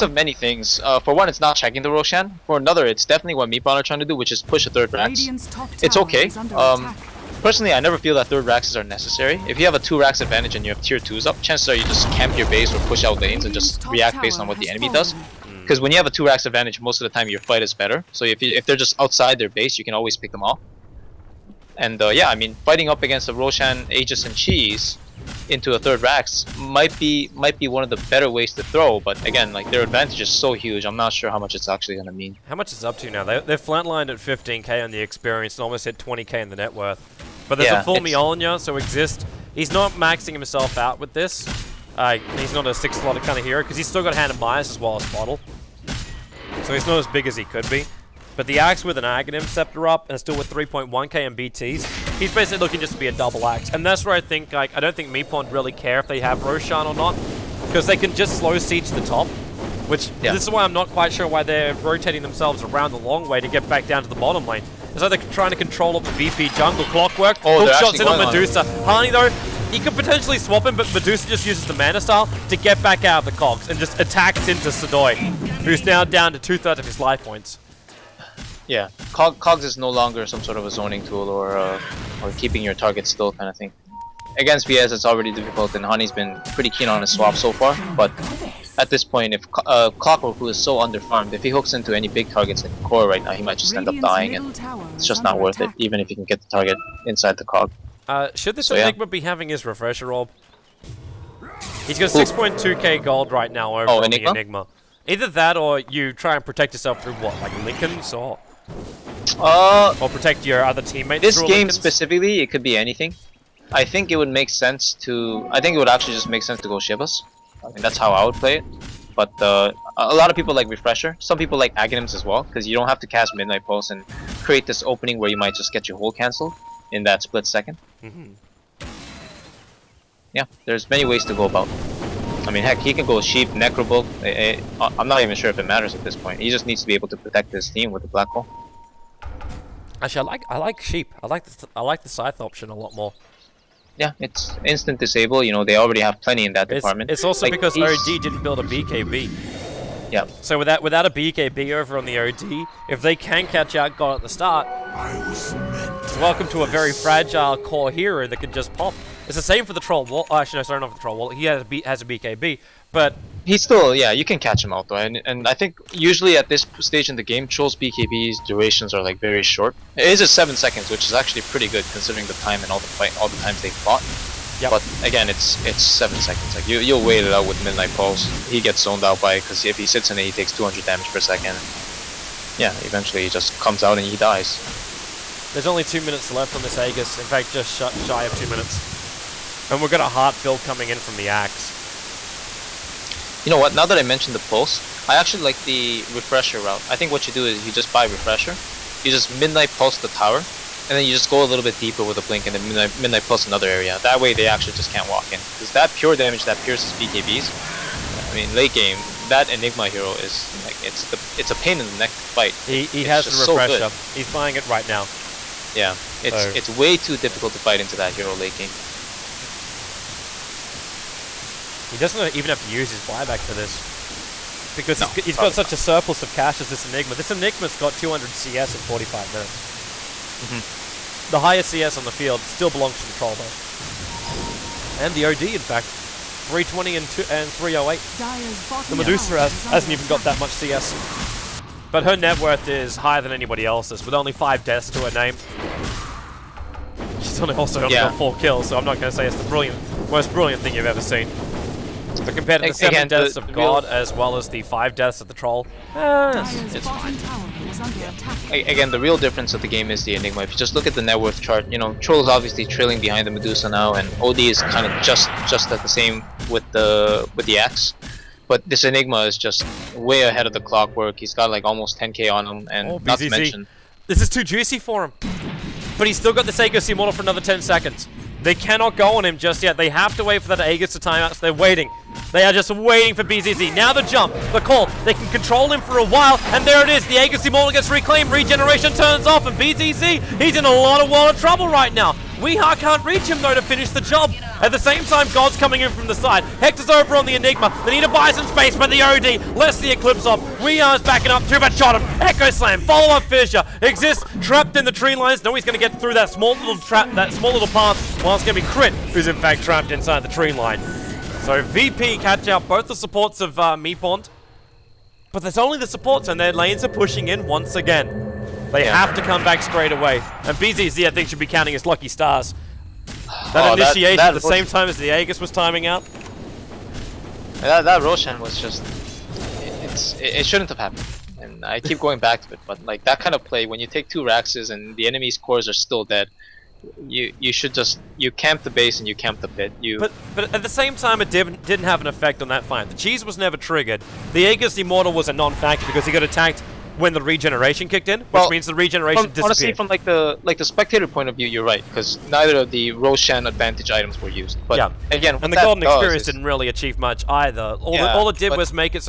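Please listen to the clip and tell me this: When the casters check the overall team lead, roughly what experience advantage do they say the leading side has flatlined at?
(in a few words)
15k.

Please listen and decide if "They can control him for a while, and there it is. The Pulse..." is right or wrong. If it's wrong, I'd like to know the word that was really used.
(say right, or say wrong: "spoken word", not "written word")
wrong: "Agassi", not "Pulse".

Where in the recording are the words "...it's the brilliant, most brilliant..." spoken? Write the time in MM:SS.
04:09.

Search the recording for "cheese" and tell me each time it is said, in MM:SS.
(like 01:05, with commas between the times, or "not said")
00:24, 05:42.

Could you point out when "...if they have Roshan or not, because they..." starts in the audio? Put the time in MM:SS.
00:55.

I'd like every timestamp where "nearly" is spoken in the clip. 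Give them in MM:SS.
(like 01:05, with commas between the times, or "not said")
not said.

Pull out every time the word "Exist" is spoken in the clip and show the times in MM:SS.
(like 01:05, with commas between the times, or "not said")
00:38, 05:03.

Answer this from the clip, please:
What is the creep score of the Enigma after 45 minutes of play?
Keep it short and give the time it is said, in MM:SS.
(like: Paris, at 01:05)
200, at 03:47.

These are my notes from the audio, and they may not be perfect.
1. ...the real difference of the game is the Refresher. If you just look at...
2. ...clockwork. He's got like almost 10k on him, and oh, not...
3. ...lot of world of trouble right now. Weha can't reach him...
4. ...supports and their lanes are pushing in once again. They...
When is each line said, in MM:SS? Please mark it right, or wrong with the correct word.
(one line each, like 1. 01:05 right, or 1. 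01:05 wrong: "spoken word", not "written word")
1. 04:18 wrong: "Enigma", not "Refresher"
2. 04:30 right
3. 04:50 right
4. 05:15 right.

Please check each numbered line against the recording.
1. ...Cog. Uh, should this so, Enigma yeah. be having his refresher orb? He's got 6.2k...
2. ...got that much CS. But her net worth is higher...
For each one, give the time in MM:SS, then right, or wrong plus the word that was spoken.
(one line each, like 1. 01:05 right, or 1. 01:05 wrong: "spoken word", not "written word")
1. 01:37 right
2. 04:00 right.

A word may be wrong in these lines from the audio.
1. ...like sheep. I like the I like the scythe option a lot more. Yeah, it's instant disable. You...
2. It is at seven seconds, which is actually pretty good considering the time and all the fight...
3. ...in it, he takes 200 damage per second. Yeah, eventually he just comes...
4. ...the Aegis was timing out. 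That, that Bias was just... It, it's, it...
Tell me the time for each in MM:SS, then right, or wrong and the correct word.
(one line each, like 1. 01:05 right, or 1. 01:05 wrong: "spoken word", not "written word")
1. 02:20 right
2. 02:49 right
3. 03:00 right
4. 05:24 wrong: "Roshan", not "Bias".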